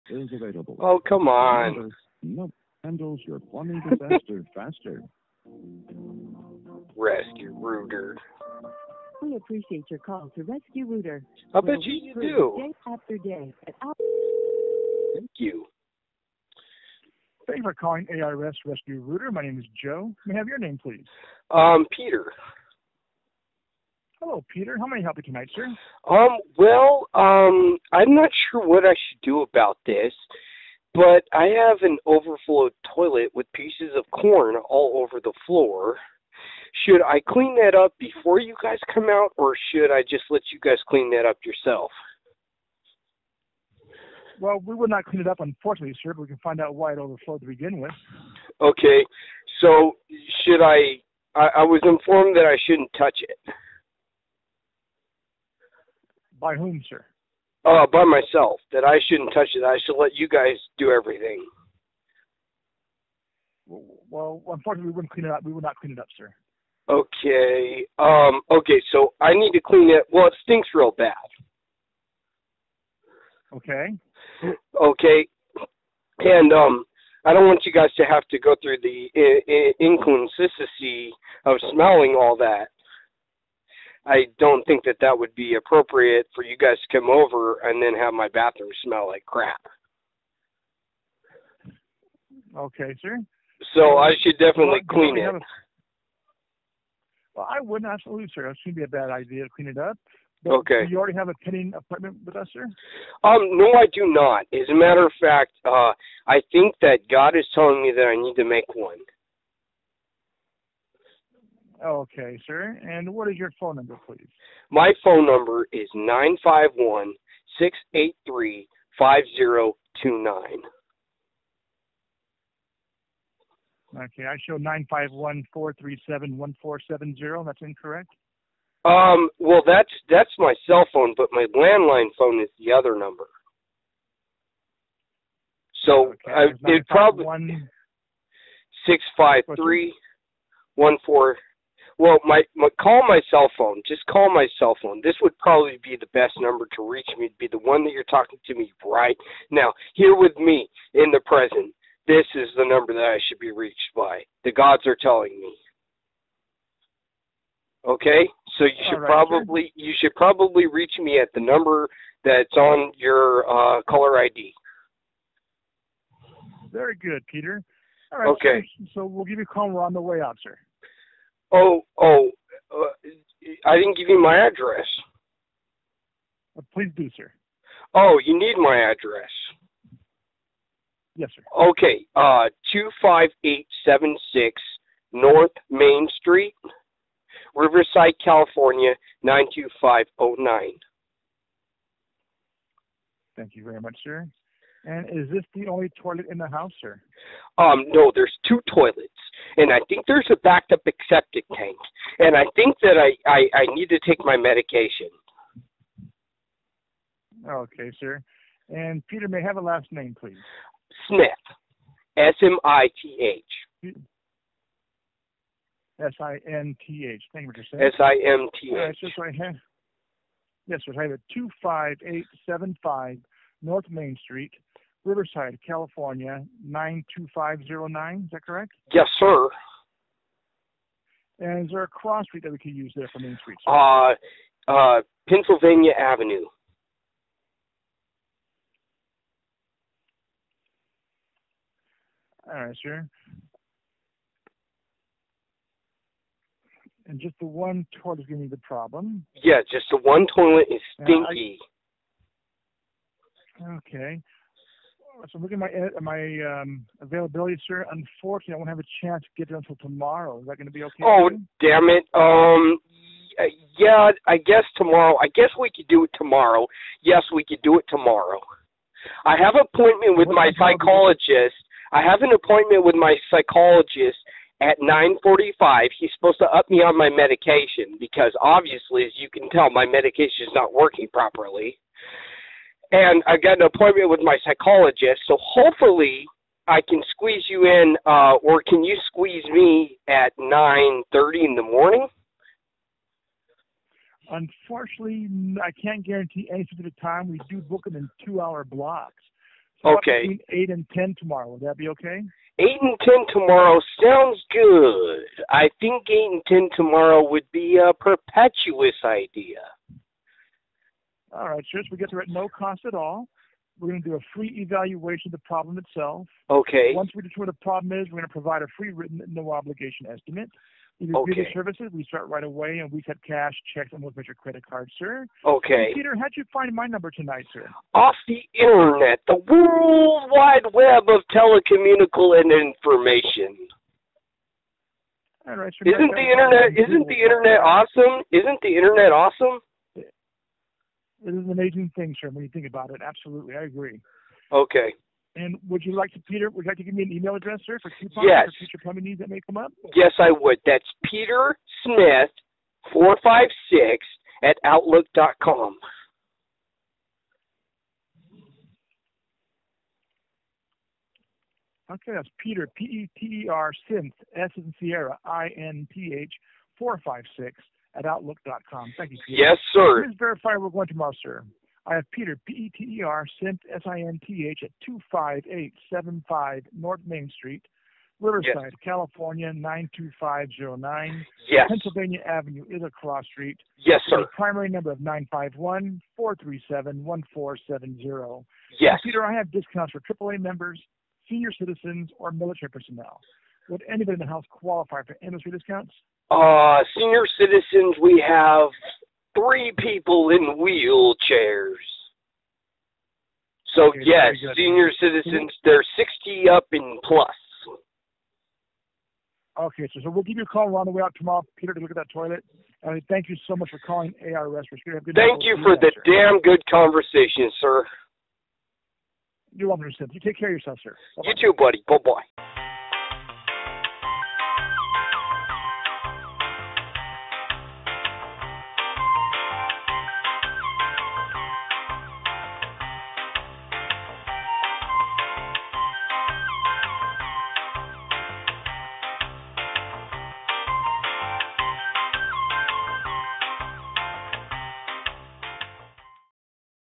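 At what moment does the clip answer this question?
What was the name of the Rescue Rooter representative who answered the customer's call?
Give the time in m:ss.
0:19.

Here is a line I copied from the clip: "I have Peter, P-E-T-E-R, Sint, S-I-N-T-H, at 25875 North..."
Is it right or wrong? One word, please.
right.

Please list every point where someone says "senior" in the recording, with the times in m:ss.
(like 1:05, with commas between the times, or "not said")
6:31, 6:36, 6:44.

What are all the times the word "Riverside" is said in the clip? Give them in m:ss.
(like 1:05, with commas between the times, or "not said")
3:07, 3:45, 6:18.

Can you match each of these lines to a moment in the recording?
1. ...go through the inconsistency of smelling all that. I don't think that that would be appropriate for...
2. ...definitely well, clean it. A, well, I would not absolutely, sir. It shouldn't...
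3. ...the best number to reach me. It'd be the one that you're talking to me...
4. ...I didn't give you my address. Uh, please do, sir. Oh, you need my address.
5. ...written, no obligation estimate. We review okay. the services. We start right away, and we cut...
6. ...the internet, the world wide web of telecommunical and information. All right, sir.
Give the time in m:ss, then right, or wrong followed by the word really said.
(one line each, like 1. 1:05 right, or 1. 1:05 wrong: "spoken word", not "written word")
1. 1:18 right
2. 1:34 right
3. 2:25 right
4. 2:53 right
5. 5:18 right
6. 5:28 right.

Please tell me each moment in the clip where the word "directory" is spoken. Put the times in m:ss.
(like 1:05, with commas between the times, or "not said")
not said.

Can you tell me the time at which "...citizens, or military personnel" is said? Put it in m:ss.
6:31.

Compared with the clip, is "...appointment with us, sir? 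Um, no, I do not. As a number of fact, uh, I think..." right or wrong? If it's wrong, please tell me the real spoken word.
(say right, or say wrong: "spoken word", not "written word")
wrong: "matter", not "number".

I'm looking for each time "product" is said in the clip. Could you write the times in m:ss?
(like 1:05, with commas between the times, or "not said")
not said.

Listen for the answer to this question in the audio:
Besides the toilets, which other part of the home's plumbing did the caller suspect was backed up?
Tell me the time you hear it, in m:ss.
3:21.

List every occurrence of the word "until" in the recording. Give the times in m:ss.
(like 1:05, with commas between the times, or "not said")
4:19.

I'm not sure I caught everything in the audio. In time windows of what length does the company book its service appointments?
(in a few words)
Two-hour blocks.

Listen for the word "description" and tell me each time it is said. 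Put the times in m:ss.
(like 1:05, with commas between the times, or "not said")
not said.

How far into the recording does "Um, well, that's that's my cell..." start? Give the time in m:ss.
2:08.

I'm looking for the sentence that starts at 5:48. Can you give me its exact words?
for future plumbing needs that may come up?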